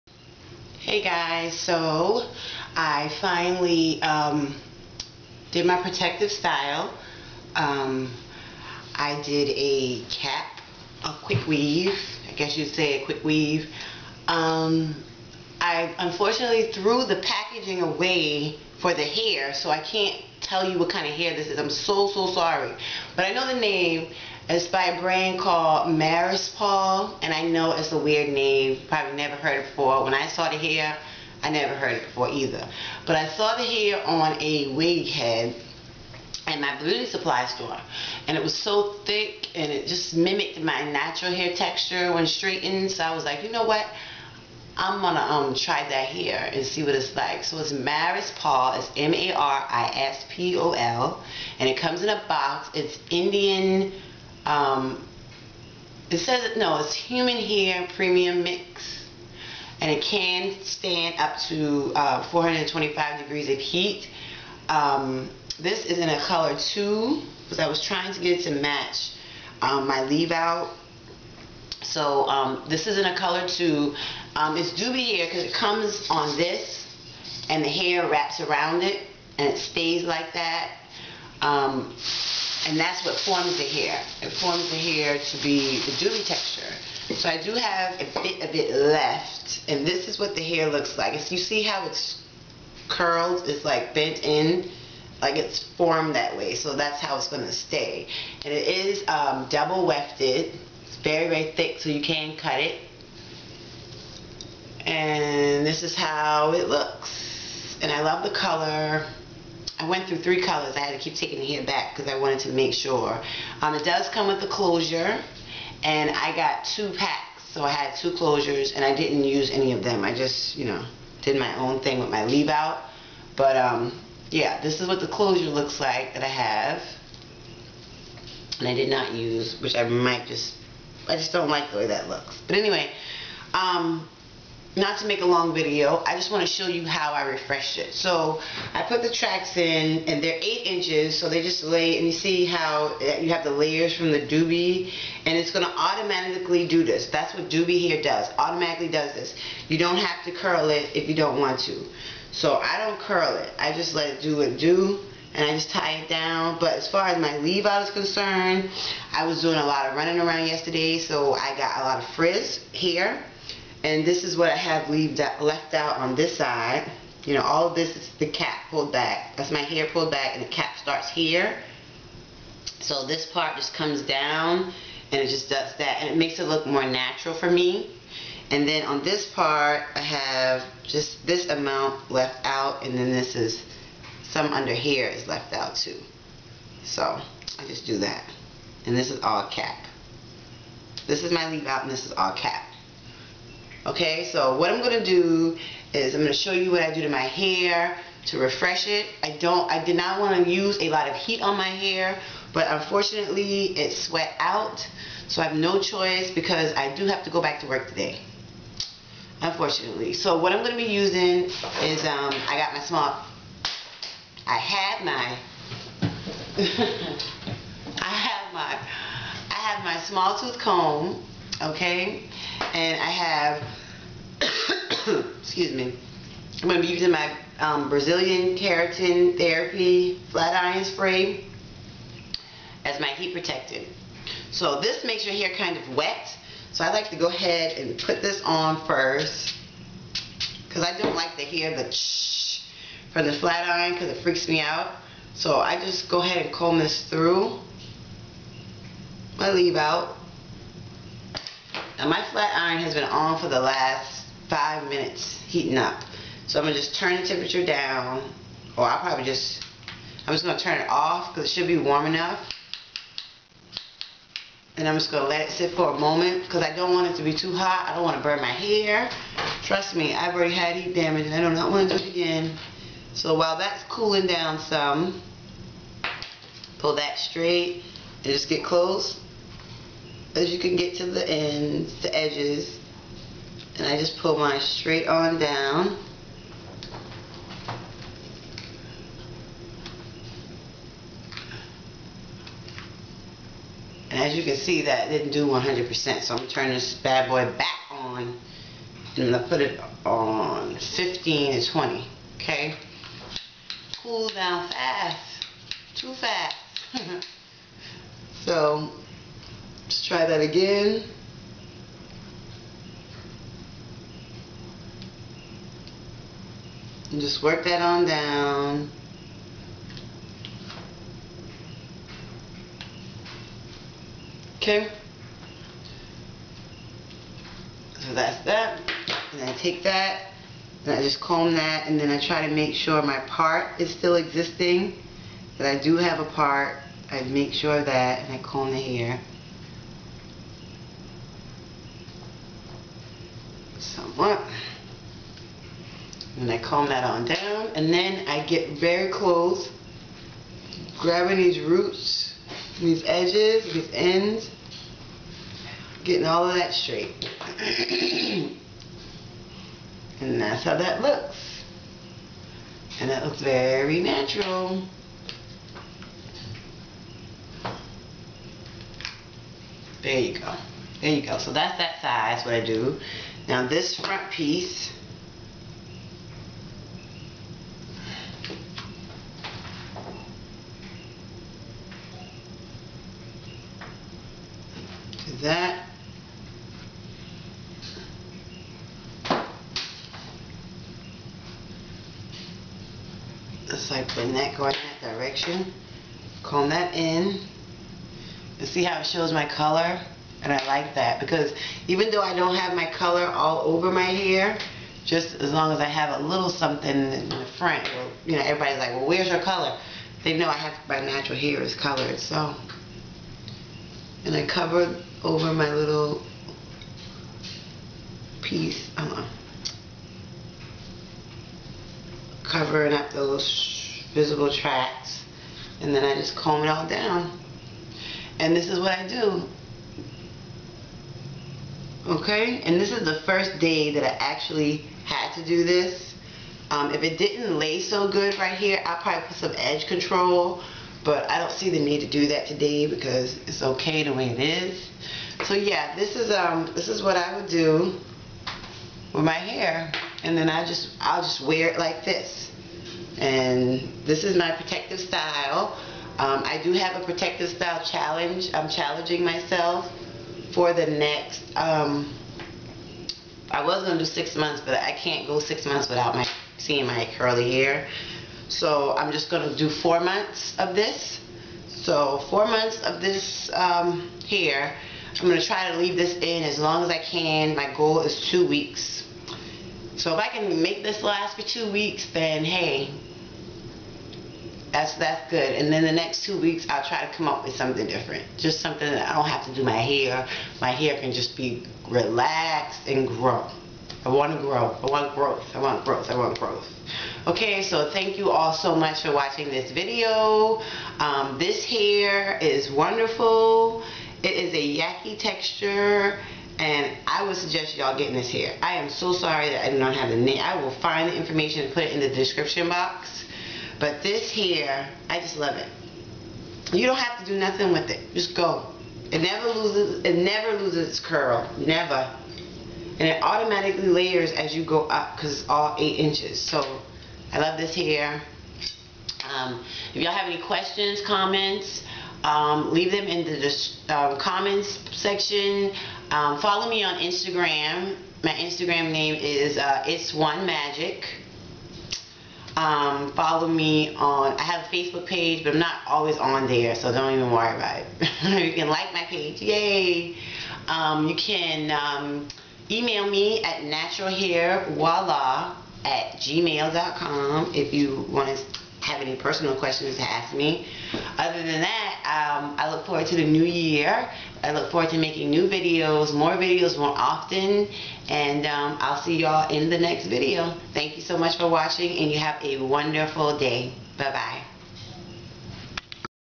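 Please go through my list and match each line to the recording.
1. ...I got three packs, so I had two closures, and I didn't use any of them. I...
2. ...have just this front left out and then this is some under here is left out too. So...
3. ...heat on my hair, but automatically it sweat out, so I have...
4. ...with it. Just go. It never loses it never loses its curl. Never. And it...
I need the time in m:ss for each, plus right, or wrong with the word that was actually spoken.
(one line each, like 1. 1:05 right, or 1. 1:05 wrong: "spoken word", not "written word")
1. 1:56 wrong: "two", not "three"
2. 2:59 wrong: "amount", not "front"
3. 3:21 wrong: "unfortunately", not "automatically"
4. 8:37 right.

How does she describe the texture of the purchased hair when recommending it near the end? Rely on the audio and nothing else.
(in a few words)
yaki.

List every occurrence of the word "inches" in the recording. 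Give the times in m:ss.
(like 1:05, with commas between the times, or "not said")
2:20, 8:45.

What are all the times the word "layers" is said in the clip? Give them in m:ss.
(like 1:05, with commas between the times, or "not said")
2:23, 8:43.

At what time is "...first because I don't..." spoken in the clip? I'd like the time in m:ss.
3:58.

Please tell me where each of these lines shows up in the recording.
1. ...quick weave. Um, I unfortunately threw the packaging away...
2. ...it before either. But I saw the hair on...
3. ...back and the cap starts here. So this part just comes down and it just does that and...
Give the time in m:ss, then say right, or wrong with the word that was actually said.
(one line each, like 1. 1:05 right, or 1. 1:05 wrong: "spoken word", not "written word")
1. 0:13 right
2. 0:31 right
3. 2:50 right.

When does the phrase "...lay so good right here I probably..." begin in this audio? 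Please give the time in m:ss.
7:17.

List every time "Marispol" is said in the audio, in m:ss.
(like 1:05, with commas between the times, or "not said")
0:25, 0:47.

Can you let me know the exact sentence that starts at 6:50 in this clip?
They know I have my natural hair is colored, so.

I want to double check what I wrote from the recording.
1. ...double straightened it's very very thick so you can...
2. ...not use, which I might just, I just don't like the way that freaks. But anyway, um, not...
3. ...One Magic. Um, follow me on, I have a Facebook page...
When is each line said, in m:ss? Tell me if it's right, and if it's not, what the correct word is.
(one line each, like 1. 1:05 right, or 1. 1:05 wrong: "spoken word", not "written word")
1. 1:39 wrong: "wefted", not "straightened"
2. 2:08 wrong: "looks", not "freaks"
3. 9:00 right.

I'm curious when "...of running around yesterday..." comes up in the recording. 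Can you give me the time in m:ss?
2:39.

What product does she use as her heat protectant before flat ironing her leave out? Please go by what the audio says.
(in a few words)
Brazilian Keratin Therapy Flat Iron Spray.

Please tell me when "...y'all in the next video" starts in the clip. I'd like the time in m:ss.
9:29.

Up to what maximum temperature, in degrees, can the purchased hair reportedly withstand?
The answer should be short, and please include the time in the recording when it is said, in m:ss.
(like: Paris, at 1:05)
425, at 1:02.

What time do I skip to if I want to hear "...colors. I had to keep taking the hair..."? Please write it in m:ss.
1:50.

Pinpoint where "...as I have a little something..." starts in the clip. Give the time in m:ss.
6:45.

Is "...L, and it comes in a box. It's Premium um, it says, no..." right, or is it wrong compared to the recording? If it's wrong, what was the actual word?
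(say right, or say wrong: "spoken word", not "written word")
wrong: "Indian", not "Premium".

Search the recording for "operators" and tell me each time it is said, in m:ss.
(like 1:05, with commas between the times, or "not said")
not said.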